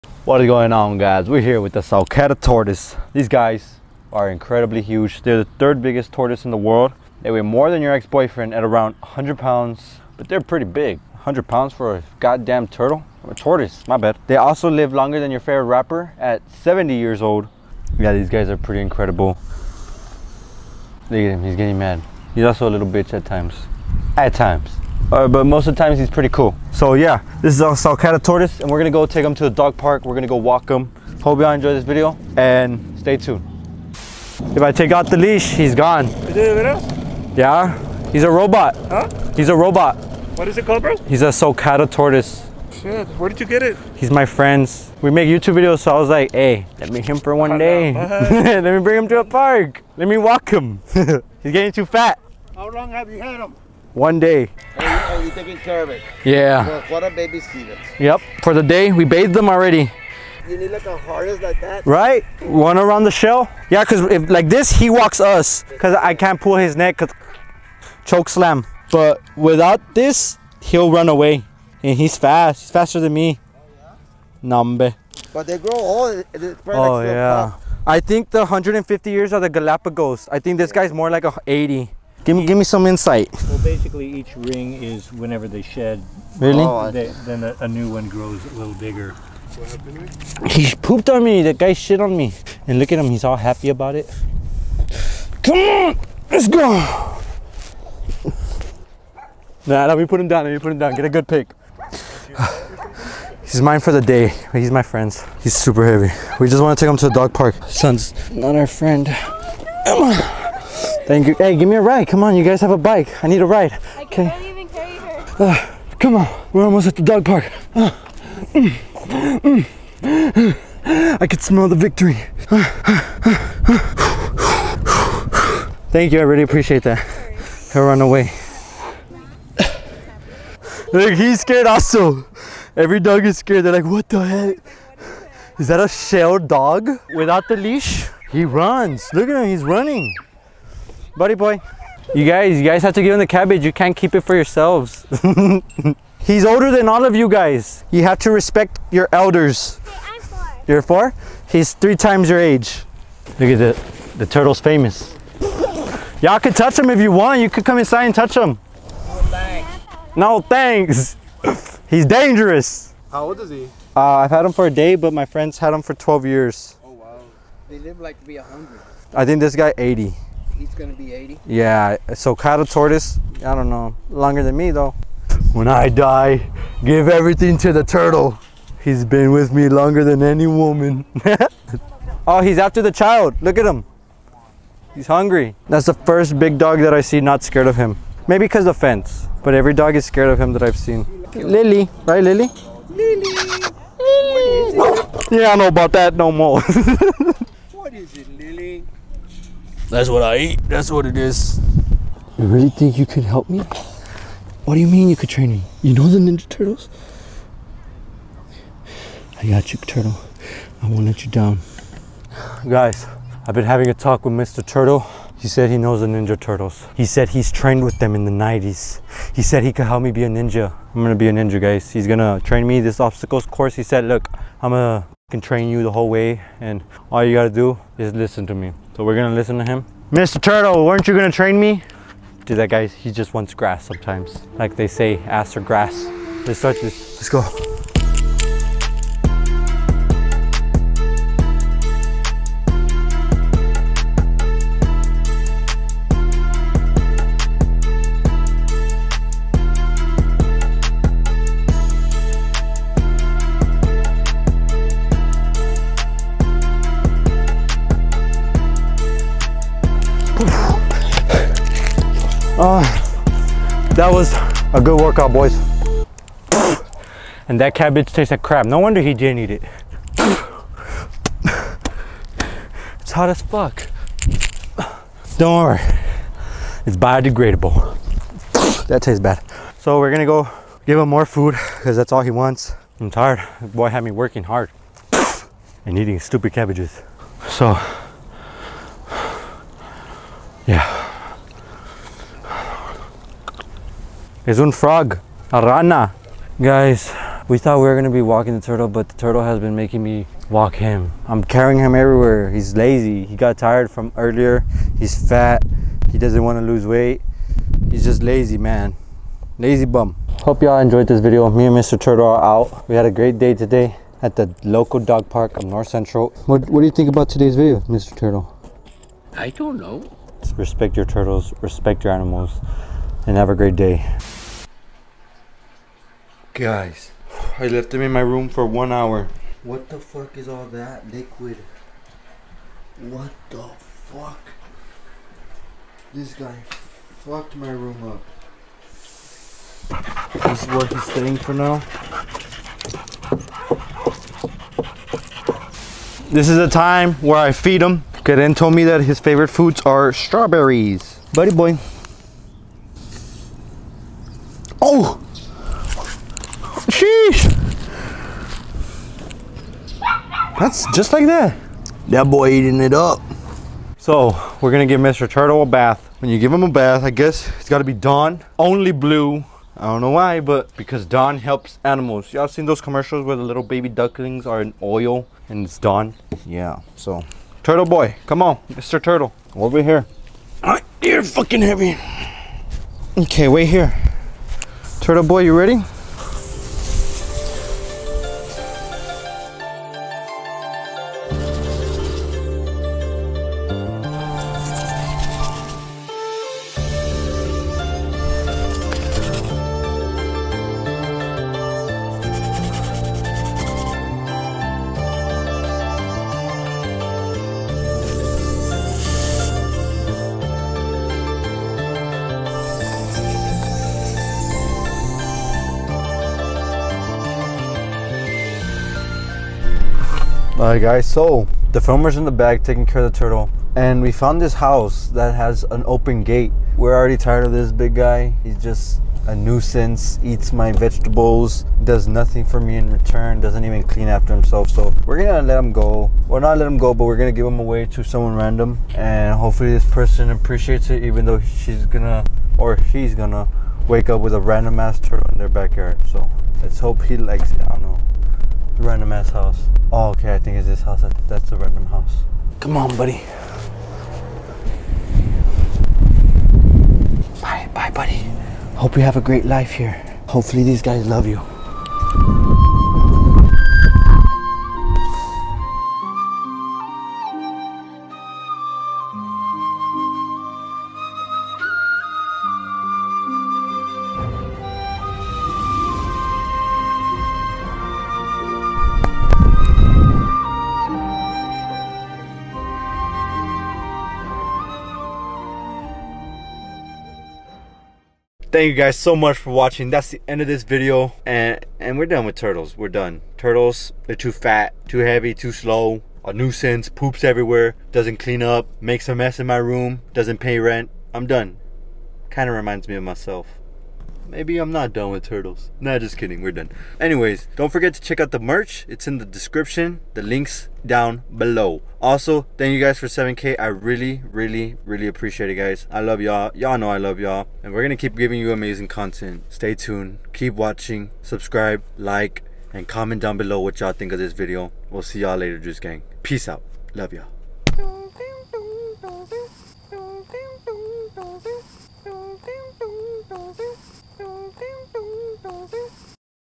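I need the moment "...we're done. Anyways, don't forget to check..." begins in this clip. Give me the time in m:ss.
8:26.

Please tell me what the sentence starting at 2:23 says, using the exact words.
You can't keep it for yourselves.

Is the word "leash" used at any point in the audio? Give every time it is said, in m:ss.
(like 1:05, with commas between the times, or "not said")
0:35, 2:17.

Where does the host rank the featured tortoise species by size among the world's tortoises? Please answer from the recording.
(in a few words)
Third biggest.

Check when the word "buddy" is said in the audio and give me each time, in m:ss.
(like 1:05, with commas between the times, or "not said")
2:21, 5:51, 7:32, 7:37.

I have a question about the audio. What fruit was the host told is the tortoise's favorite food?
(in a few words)
Strawberries.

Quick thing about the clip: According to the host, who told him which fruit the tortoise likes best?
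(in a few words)
Karen.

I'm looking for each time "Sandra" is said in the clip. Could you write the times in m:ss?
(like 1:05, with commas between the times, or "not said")
not said.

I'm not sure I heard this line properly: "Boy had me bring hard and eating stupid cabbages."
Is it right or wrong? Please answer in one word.
wrong.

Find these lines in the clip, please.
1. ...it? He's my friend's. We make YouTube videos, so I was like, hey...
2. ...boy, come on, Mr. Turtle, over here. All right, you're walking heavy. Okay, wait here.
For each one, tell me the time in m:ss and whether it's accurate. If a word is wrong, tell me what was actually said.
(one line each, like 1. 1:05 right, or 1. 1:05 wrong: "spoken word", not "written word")
1. 0:43 right
2. 6:17 wrong: "fucking", not "walking".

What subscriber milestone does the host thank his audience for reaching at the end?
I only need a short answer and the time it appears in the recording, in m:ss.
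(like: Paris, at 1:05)
7K, at 8:33.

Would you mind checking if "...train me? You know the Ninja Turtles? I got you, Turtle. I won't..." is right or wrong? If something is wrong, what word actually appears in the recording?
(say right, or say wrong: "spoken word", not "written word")
right.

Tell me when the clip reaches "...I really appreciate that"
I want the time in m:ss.
2:06.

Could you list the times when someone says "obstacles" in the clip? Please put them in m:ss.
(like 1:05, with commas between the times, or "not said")
3:43.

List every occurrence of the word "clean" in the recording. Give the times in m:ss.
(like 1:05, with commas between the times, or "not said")
7:13, 8:18.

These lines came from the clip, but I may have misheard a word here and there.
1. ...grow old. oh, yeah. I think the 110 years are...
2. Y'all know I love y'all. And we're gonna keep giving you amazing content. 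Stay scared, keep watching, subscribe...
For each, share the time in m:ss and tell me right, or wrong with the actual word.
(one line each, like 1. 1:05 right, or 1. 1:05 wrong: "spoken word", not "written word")
1. 1:15 wrong: "150", not "110"
2. 8:36 wrong: "tuned", not "scared".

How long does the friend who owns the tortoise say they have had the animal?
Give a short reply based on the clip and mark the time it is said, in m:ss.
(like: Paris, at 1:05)
12 years, at 2:45.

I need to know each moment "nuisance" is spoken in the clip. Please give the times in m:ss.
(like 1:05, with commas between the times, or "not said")
7:09, 8:16.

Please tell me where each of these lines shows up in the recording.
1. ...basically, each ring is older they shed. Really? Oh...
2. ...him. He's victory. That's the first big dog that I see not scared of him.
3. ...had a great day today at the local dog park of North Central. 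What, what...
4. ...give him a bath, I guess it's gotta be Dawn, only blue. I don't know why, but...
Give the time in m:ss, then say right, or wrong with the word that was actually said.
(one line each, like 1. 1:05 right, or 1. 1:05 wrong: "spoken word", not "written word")
1. 1:23 wrong: "whenever", not "older"
2. 3:03 wrong: "hungry", not "victory"
3. 5:12 right
4. 6:06 right.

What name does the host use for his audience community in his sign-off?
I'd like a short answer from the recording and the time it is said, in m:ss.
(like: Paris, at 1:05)
Juice Gang, at 8:45.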